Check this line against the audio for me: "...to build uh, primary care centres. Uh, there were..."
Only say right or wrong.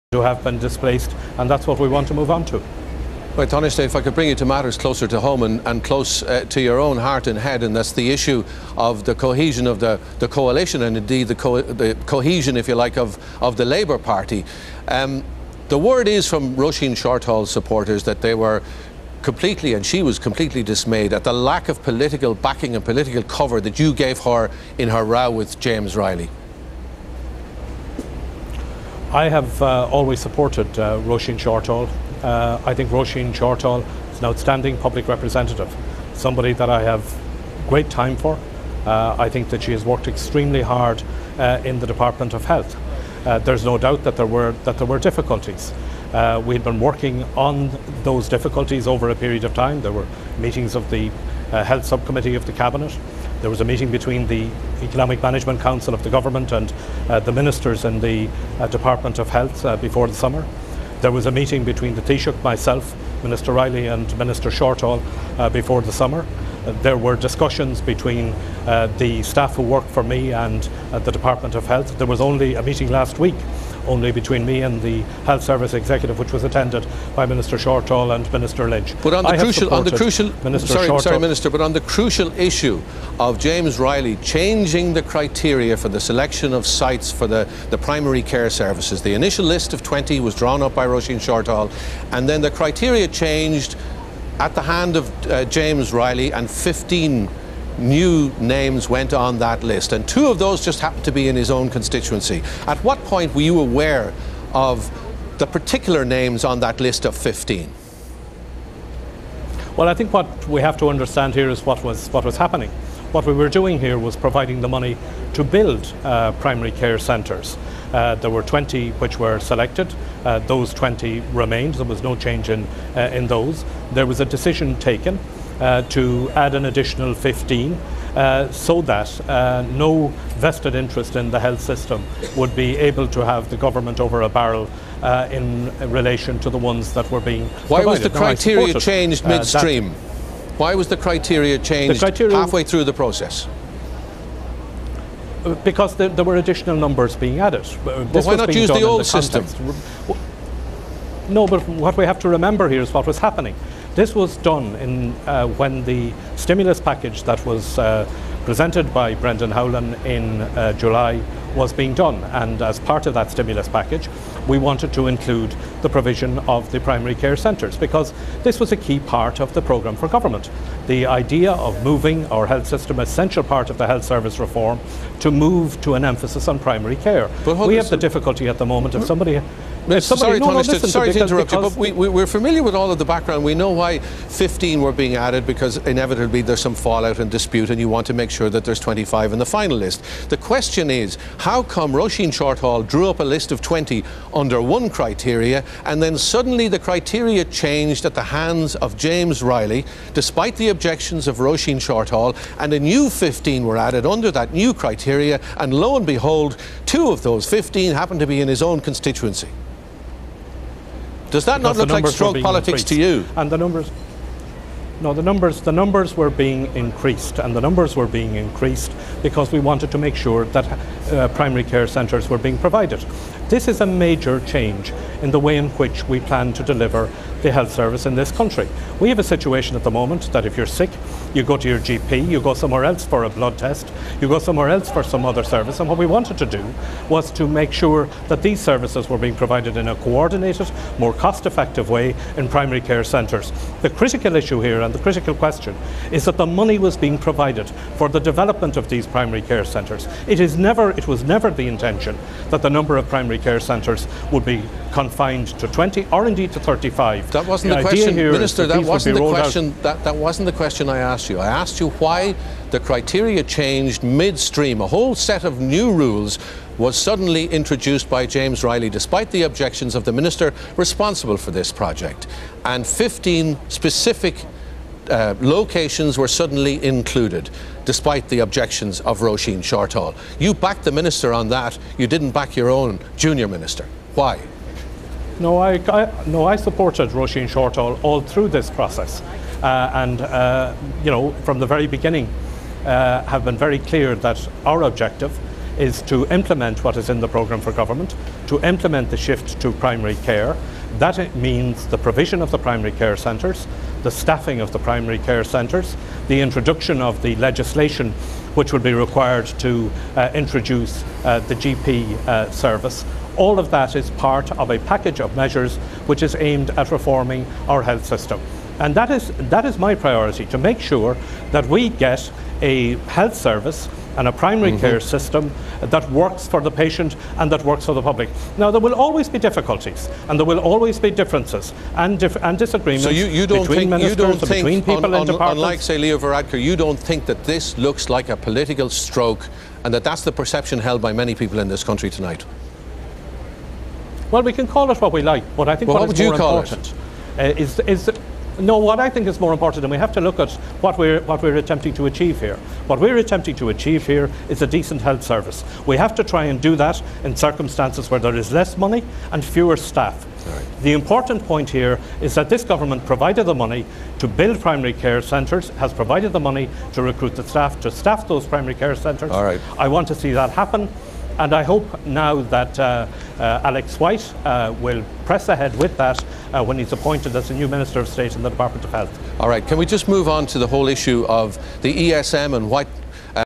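right.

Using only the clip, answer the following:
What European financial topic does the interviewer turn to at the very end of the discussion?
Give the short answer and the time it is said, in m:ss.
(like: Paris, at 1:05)
ESM, at 6:22.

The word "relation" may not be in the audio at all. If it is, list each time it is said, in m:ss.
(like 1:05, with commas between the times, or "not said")
2:15.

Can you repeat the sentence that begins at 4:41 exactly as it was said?
You didn't back your own junior minister.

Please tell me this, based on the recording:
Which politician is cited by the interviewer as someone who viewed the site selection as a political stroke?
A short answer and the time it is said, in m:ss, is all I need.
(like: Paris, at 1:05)
Leo Varadkar, at 5:35.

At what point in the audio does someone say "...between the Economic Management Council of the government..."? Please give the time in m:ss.
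0:53.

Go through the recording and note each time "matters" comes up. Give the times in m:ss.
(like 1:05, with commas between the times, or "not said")
0:04.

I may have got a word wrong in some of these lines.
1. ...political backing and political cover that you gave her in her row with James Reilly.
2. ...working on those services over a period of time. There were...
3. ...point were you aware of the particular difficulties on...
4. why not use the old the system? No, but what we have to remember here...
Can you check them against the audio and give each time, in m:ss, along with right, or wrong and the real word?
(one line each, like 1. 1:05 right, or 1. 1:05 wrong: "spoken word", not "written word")
1. 0:21 right
2. 0:46 wrong: "difficulties", not "services"
3. 1:43 wrong: "names", not "difficulties"
4. 2:27 right.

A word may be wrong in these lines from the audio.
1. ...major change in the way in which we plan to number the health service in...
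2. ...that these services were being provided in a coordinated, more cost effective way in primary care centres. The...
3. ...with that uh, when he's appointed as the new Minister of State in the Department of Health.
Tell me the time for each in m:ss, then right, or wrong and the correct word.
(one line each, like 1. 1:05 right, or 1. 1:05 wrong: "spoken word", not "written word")
1. 3:43 wrong: "deliver", not "number"
2. 3:58 right
3. 6:15 right.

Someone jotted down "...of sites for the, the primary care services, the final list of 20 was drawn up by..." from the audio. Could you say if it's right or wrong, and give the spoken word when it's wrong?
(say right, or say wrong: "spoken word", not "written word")
wrong: "initial", not "final".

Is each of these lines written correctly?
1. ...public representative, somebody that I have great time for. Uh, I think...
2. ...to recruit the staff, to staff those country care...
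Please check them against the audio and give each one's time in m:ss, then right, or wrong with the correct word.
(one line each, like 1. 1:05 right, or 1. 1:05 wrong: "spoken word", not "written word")
1. 0:34 right
2. 6:06 wrong: "primary", not "country".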